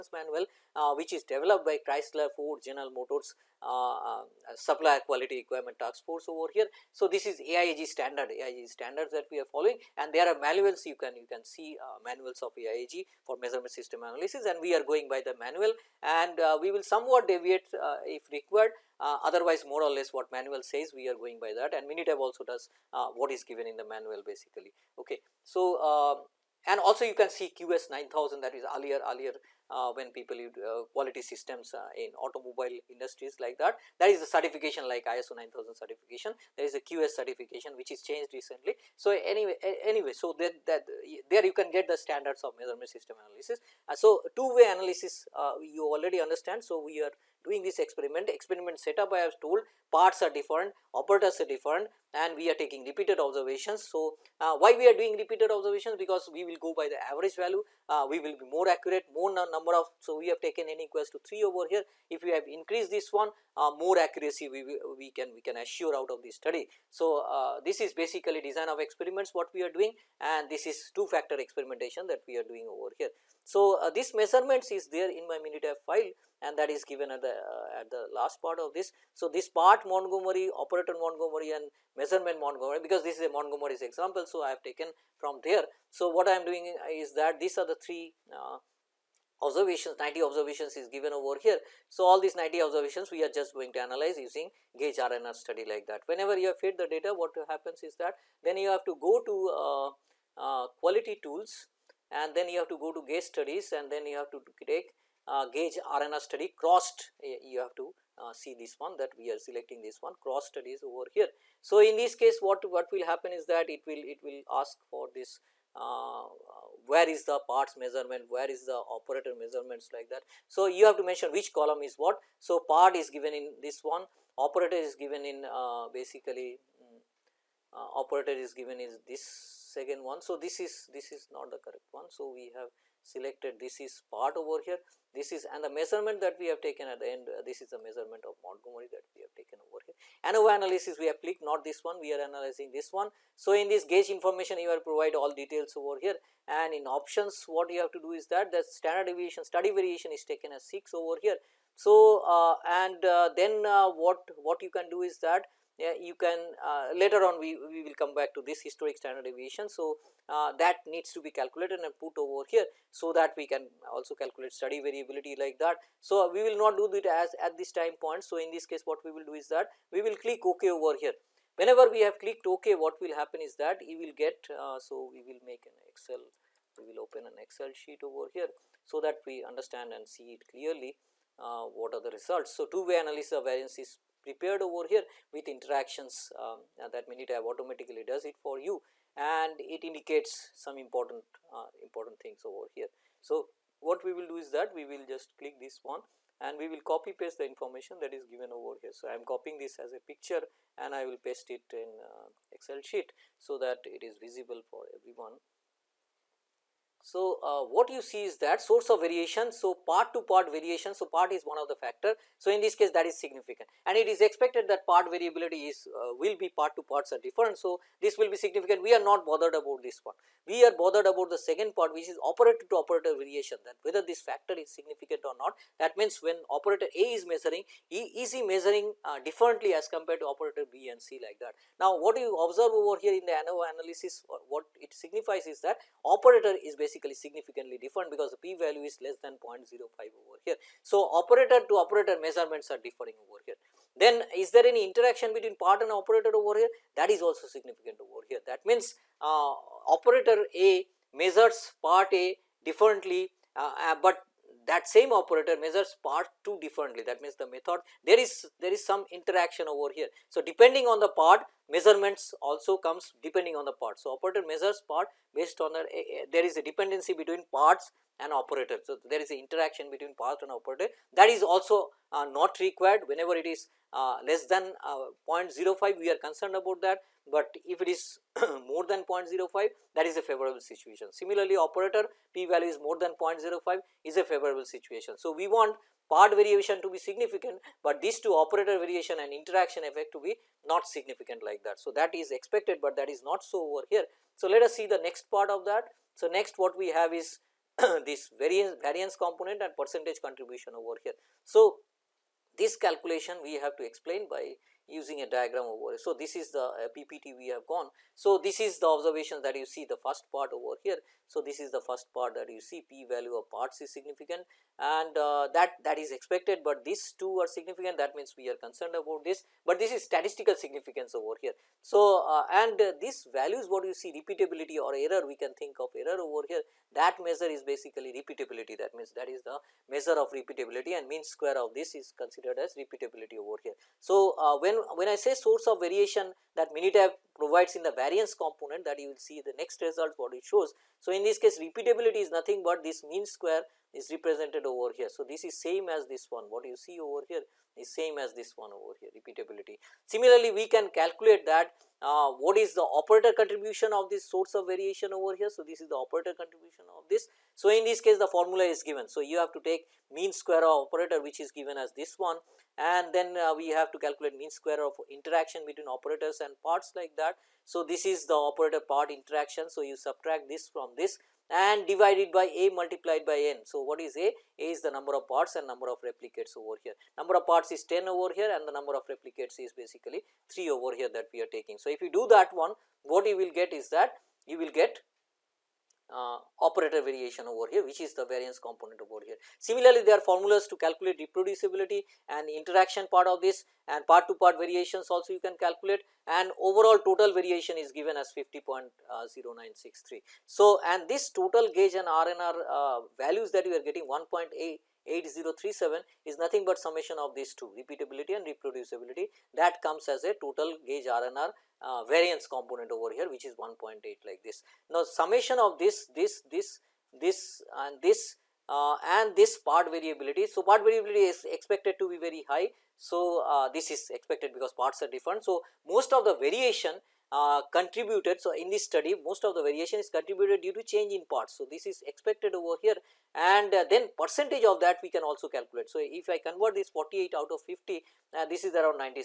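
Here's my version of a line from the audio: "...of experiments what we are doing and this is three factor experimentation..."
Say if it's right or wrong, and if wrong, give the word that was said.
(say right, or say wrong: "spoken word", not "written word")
wrong: "two", not "three".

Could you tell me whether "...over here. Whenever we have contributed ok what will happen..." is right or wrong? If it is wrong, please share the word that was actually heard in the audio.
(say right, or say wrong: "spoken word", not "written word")
wrong: "clicked", not "contributed".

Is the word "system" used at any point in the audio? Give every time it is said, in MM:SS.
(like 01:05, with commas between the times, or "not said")
00:13, 00:31, 00:42.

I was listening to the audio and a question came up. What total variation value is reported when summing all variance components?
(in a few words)
50.0963.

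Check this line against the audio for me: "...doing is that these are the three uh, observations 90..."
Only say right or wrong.
right.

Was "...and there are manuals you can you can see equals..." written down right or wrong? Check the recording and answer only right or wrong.
wrong.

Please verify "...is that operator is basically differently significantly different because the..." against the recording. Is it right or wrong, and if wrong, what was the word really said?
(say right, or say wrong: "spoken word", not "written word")
wrong: "basically", not "differently".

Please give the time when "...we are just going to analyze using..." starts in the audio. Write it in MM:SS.
01:33.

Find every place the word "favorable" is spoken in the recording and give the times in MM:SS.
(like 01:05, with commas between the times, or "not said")
04:40, 04:44.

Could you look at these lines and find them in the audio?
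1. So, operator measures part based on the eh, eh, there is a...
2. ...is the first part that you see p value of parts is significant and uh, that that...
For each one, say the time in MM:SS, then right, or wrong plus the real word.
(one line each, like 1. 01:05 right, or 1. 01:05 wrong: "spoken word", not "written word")
1. 04:23 right
2. 05:11 right.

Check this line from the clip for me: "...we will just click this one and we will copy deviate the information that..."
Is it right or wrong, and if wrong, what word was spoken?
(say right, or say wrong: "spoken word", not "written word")
wrong: "paste", not "deviate".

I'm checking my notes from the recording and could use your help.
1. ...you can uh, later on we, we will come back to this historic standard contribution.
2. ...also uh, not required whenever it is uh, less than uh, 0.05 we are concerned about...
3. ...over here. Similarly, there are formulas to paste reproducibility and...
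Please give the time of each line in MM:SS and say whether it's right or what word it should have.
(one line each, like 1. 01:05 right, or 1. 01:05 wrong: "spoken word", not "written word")
1. 02:35 wrong: "deviation", not "contribution"
2. 04:31 right
3. 06:29 wrong: "calculate", not "paste".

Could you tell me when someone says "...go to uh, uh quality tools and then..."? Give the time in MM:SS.
01:39.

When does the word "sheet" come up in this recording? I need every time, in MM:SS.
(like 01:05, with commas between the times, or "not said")
02:57, 03:22.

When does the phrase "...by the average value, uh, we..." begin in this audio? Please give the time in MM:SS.
00:56.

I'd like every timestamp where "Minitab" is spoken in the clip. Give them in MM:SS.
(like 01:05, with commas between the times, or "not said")
00:21, 01:15, 03:07, 05:36.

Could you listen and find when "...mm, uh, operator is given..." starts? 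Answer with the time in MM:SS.
02:06.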